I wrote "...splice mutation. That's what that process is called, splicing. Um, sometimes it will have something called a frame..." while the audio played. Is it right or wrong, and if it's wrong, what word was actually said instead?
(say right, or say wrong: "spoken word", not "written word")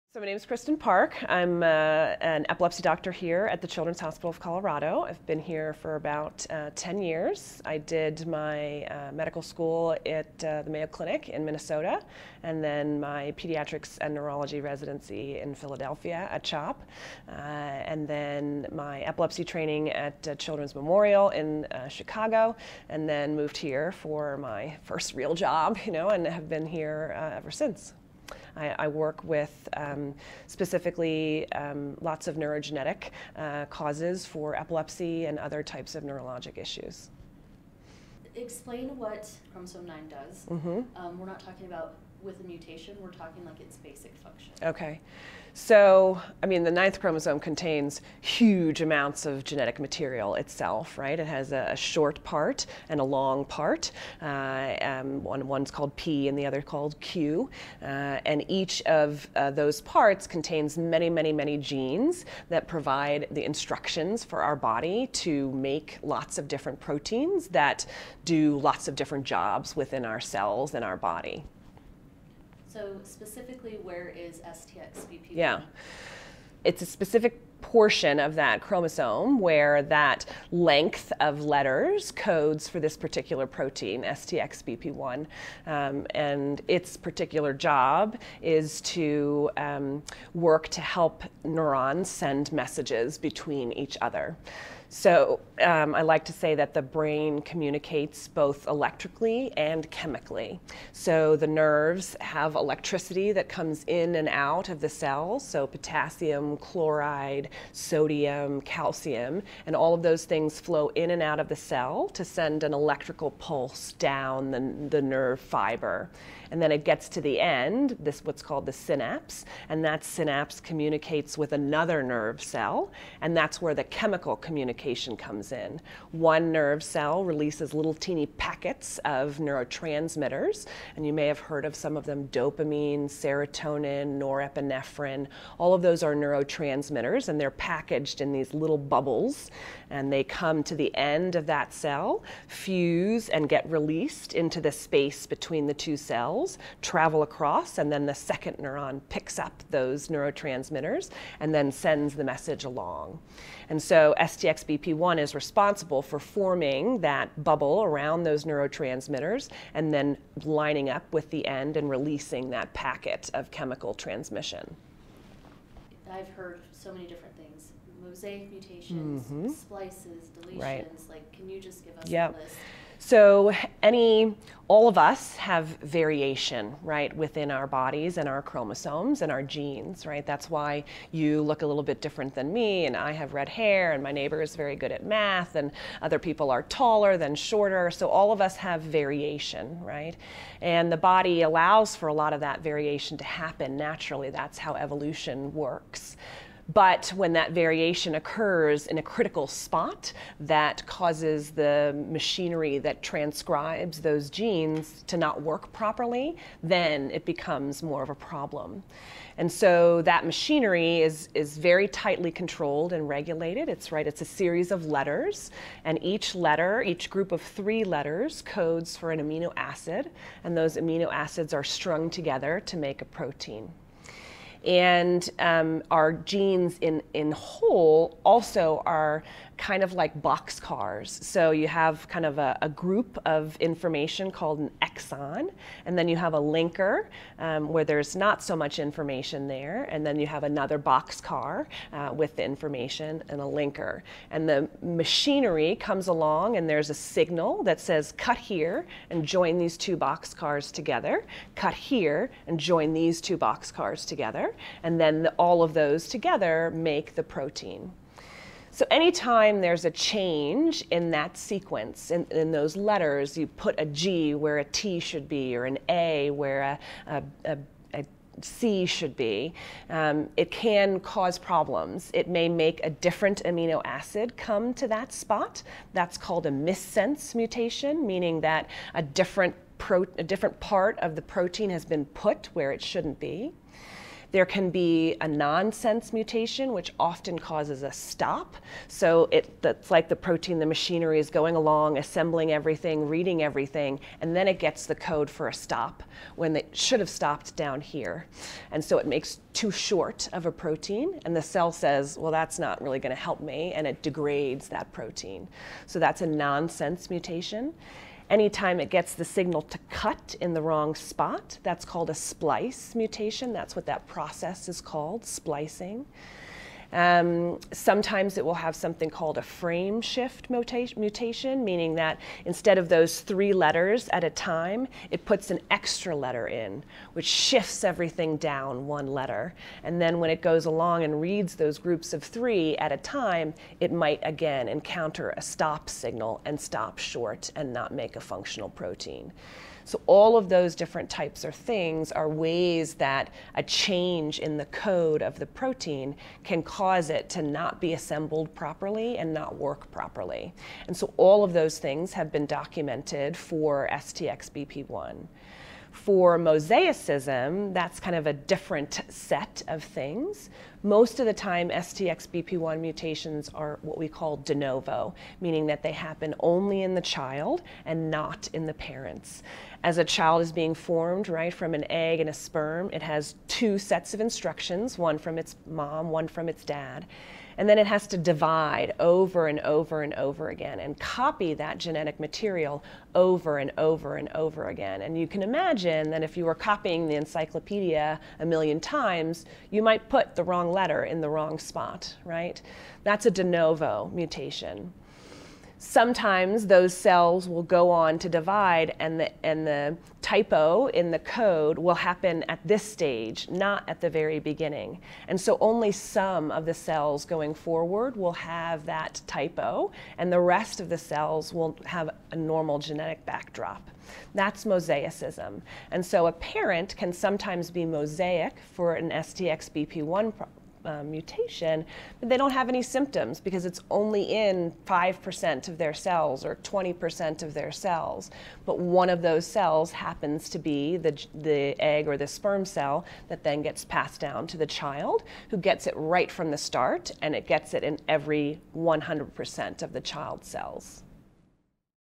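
right.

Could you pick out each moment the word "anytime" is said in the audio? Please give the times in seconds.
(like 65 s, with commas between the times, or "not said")
258 s, 308 s.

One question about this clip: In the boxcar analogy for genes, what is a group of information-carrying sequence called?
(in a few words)
exon.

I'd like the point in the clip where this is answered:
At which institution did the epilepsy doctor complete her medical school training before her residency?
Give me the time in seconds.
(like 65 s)
10 s.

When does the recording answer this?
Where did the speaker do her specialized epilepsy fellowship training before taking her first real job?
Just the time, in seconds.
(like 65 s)
20 s.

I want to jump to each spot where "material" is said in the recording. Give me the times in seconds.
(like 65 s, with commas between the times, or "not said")
49 s, 382 s.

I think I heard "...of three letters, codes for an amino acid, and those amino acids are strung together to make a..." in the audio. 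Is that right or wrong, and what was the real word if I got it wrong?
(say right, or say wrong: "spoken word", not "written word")
right.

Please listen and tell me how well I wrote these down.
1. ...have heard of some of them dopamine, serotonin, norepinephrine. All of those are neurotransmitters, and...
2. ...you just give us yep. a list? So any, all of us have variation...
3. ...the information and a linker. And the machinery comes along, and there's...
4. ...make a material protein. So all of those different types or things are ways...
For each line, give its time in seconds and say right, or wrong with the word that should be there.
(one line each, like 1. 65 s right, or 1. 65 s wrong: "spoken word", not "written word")
1. 131 s right
2. 171 s right
3. 242 s right
4. 337 s wrong: "functional", not "material".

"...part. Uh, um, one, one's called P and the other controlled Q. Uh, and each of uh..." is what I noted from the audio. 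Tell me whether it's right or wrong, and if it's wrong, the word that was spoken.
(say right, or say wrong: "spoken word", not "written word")
wrong: "called", not "controlled".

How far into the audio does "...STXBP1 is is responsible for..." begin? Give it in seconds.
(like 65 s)
154 s.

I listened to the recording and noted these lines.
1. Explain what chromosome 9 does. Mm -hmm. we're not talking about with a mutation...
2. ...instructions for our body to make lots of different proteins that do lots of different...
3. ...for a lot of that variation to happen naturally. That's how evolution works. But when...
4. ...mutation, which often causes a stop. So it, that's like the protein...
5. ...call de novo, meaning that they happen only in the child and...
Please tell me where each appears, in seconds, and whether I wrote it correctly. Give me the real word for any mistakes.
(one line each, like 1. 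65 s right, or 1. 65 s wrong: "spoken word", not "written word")
1. 38 s right
2. 63 s right
3. 191 s right
4. 286 s right
5. 364 s right.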